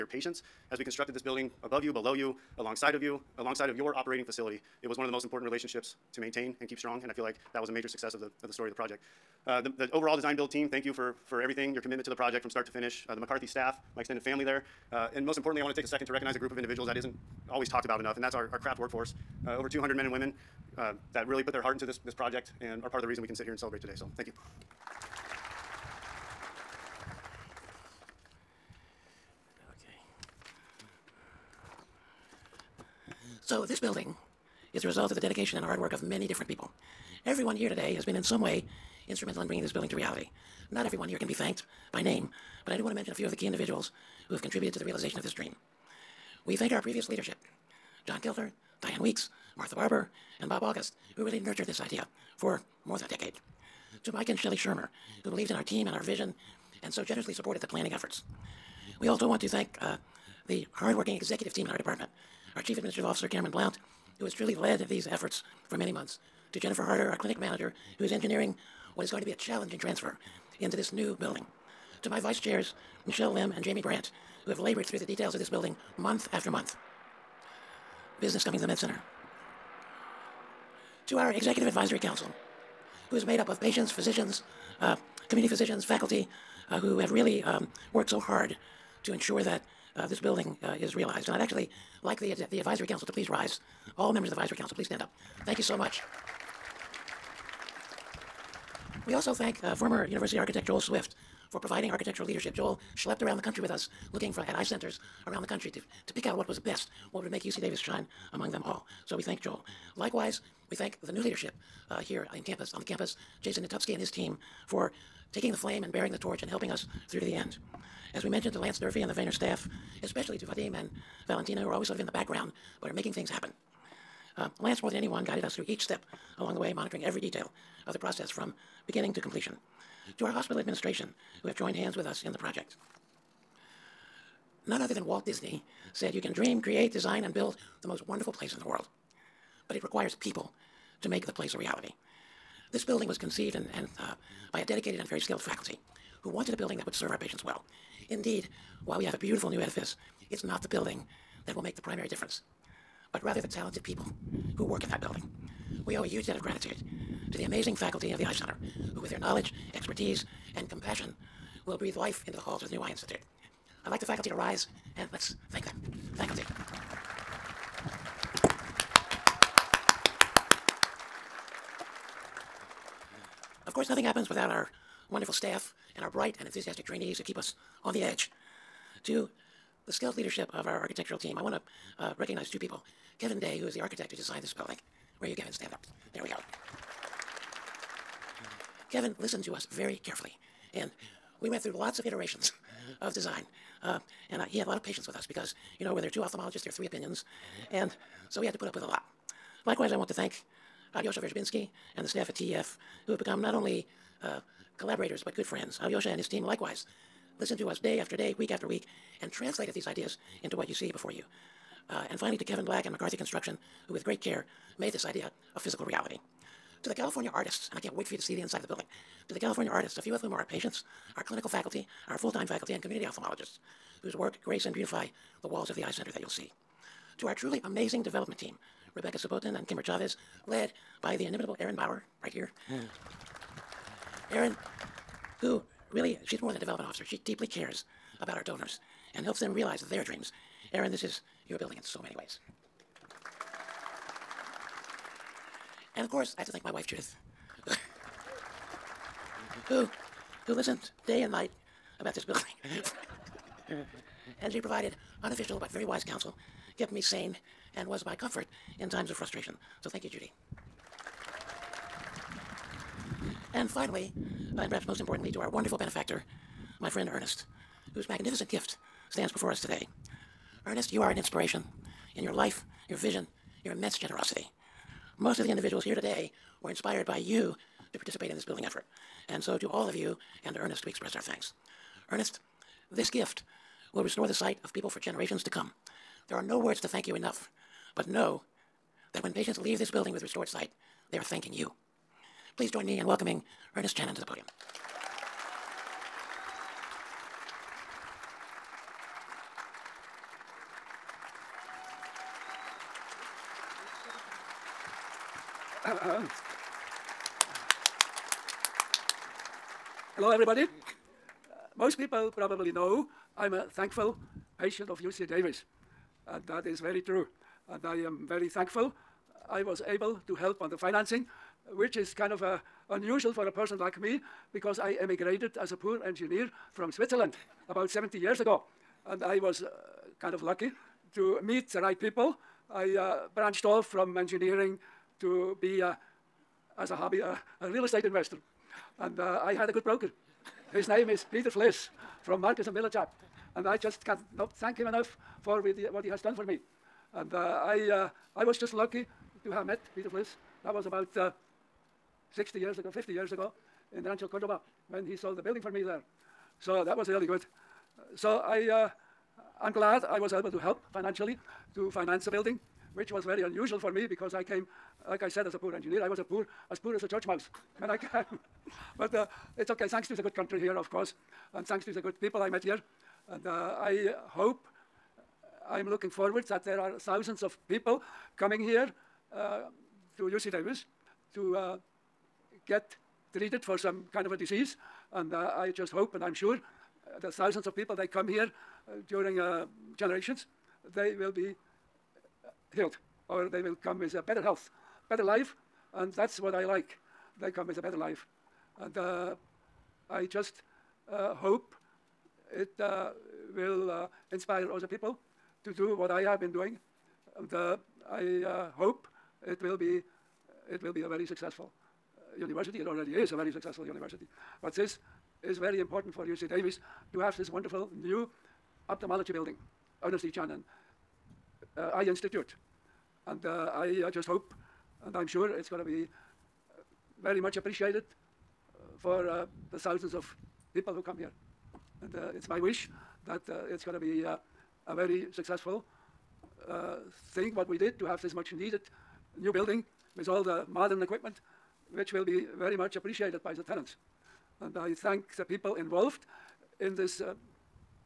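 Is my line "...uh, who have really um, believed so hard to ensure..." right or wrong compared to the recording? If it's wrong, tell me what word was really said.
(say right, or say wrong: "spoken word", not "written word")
wrong: "worked", not "believed".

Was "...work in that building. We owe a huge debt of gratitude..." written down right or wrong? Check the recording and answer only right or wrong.
right.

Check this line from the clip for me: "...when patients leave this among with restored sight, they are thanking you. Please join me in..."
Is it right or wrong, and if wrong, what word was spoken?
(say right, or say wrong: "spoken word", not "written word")
wrong: "building", not "among".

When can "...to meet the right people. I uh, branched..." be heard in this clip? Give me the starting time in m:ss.
5:31.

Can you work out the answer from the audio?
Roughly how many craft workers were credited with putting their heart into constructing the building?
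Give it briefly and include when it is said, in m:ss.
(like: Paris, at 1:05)
over 200, at 0:19.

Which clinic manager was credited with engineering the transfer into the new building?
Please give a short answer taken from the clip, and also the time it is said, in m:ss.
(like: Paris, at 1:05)
Jennifer Harder, at 1:06.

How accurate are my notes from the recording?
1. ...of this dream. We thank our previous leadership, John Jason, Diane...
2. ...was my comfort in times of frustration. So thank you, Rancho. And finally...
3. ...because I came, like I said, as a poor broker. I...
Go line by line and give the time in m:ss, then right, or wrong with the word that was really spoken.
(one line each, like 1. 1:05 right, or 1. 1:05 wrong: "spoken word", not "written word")
1. 0:45 wrong: "Gilder", not "Jason"
2. 4:17 wrong: "Judy", not "Rancho"
3. 6:04 wrong: "engineer", not "broker".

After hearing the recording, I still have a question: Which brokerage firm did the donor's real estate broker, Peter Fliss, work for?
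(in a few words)
Marcus and Millichap.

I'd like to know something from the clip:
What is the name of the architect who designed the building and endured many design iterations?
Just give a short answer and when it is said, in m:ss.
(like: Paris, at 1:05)
Kevin Day, at 3:03.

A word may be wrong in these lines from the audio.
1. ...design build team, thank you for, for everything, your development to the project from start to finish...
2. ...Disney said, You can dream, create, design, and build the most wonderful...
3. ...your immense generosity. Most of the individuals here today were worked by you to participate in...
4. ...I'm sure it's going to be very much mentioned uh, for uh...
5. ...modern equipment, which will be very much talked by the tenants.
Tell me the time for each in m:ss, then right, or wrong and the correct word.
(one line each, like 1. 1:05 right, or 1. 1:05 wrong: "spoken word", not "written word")
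1. 0:10 wrong: "commitment", not "development"
2. 2:15 right
3. 4:33 wrong: "inspired", not "worked"
4. 7:05 wrong: "appreciated", not "mentioned"
5. 7:20 wrong: "appreciated", not "talked".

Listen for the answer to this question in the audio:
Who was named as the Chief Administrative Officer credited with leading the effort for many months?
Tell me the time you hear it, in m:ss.
1:03.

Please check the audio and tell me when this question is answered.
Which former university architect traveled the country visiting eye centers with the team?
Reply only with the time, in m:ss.
1:40.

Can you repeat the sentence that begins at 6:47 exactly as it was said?
And um, uh, I uh, hope it will be it will be a very successful uh, university.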